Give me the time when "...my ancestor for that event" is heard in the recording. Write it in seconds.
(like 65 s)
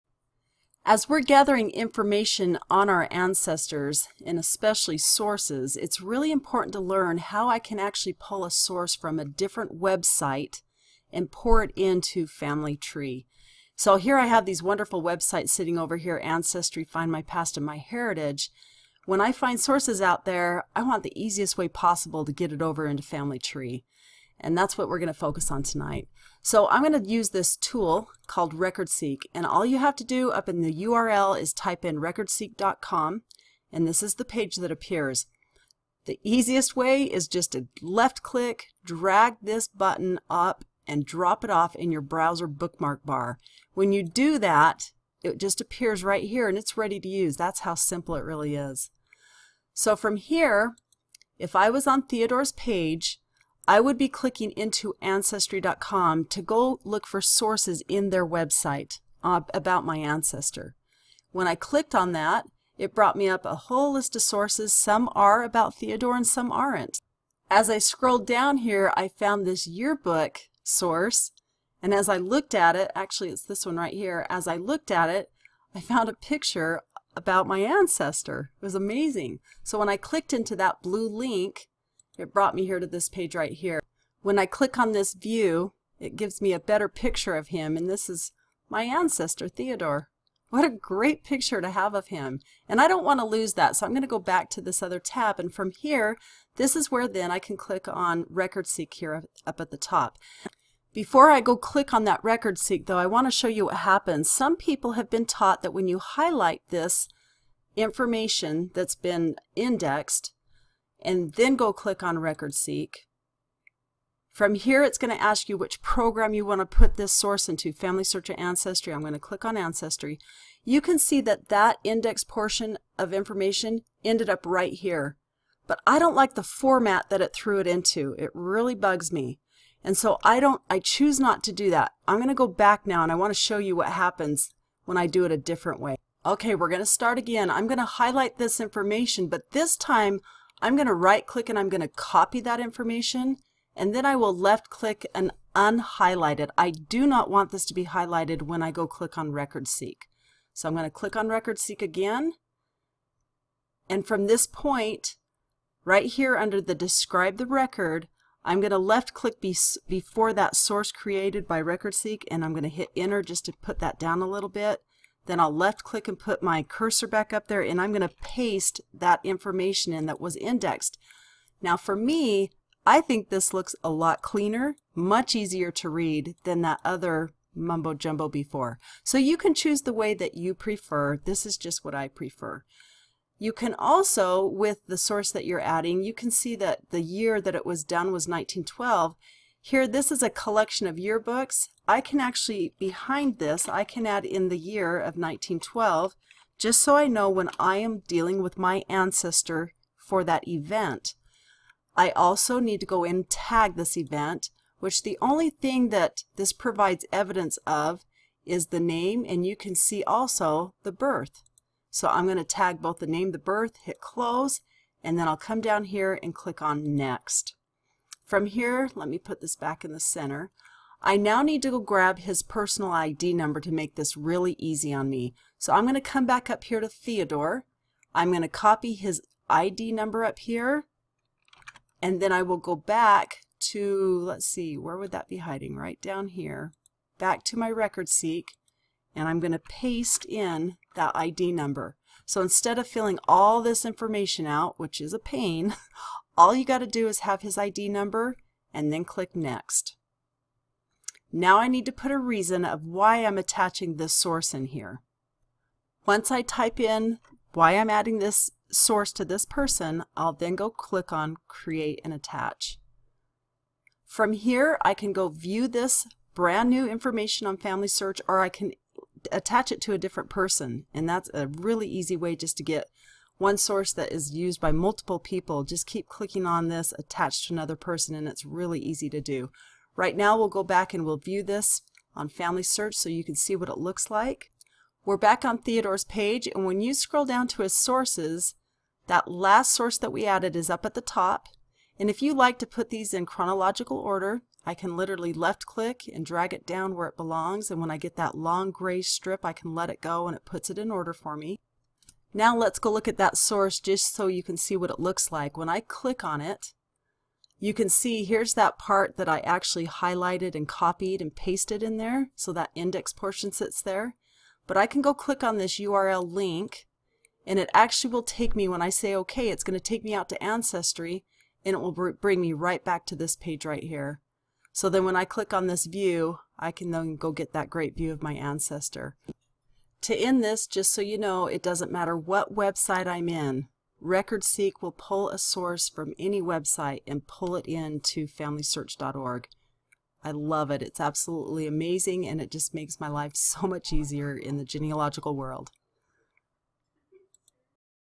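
198 s.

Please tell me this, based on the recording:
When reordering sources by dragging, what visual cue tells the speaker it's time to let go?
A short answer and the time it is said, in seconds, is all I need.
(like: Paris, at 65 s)
long gray strip, at 298 s.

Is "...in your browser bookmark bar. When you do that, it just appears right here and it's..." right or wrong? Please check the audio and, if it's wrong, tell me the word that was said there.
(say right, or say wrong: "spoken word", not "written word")
right.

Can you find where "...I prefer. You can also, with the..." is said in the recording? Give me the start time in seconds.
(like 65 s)
181 s.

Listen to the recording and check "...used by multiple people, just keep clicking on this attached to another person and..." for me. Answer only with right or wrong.
right.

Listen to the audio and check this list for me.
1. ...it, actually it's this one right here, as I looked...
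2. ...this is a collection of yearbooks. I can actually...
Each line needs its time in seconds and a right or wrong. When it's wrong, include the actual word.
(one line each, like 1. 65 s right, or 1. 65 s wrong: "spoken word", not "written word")
1. 72 s right
2. 189 s right.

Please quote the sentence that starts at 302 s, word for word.
Now let's go look at that source just so you can see what it looks like.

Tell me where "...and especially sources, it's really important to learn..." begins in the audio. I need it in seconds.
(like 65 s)
4 s.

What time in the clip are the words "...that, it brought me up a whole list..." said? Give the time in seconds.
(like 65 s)
62 s.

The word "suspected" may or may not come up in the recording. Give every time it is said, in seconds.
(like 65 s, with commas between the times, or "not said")
not said.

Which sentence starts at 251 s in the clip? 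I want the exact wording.
Now I need to put a reason of why I'm attaching this source in here.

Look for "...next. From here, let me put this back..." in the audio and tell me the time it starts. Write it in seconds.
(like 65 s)
216 s.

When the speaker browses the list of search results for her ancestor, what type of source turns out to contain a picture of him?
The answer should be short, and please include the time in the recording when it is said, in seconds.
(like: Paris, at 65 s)
yearbook, at 69 s.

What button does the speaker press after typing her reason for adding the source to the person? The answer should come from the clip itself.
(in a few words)
Create and Attach.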